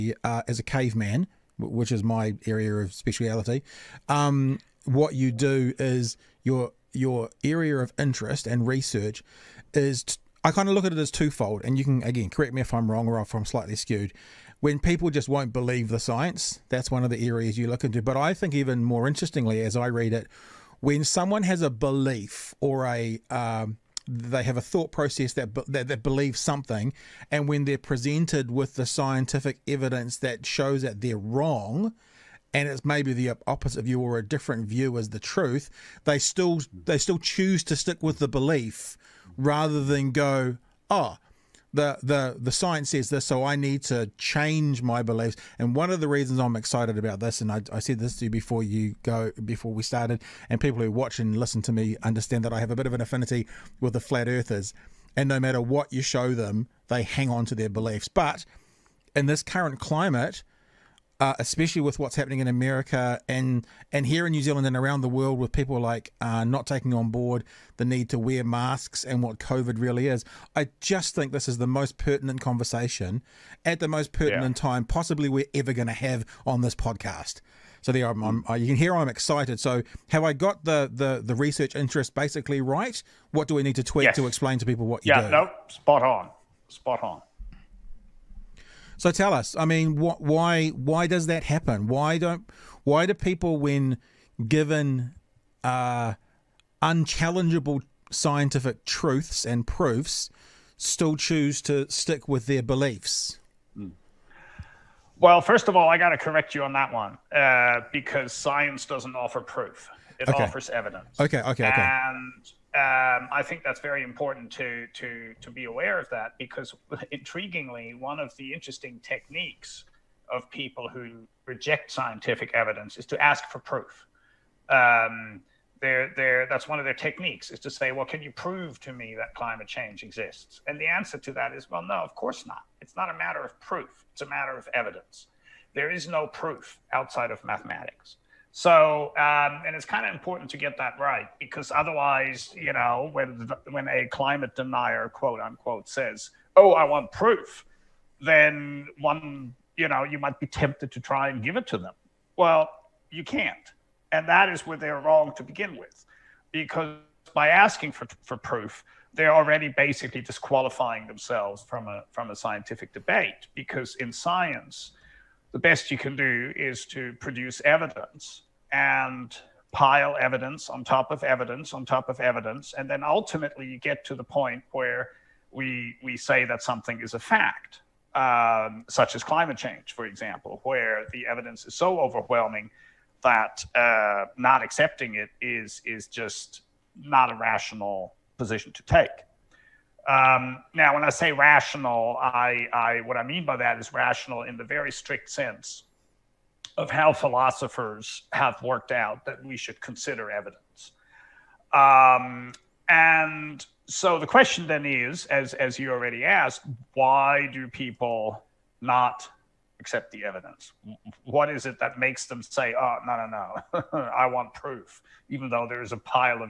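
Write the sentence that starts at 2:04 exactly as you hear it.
Um, they're, they're, that's one of their techniques is to say, well, can you prove to me that climate change exists?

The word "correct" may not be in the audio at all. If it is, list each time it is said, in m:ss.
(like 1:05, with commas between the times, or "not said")
0:12, 1:46.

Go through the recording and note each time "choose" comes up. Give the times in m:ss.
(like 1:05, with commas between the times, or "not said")
0:37, 1:41.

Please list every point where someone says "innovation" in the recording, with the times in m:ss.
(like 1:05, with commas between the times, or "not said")
not said.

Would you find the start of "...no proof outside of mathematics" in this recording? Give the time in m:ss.
2:16.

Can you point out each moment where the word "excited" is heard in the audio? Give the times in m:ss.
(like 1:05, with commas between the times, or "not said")
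0:46, 1:19.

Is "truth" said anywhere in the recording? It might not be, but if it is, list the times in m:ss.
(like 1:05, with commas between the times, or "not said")
0:35, 1:38.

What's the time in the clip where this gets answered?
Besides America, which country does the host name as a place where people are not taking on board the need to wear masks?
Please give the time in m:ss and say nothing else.
1:04.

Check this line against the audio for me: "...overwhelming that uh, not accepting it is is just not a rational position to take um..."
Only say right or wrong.
right.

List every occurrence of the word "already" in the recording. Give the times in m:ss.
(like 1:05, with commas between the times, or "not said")
2:39, 3:25.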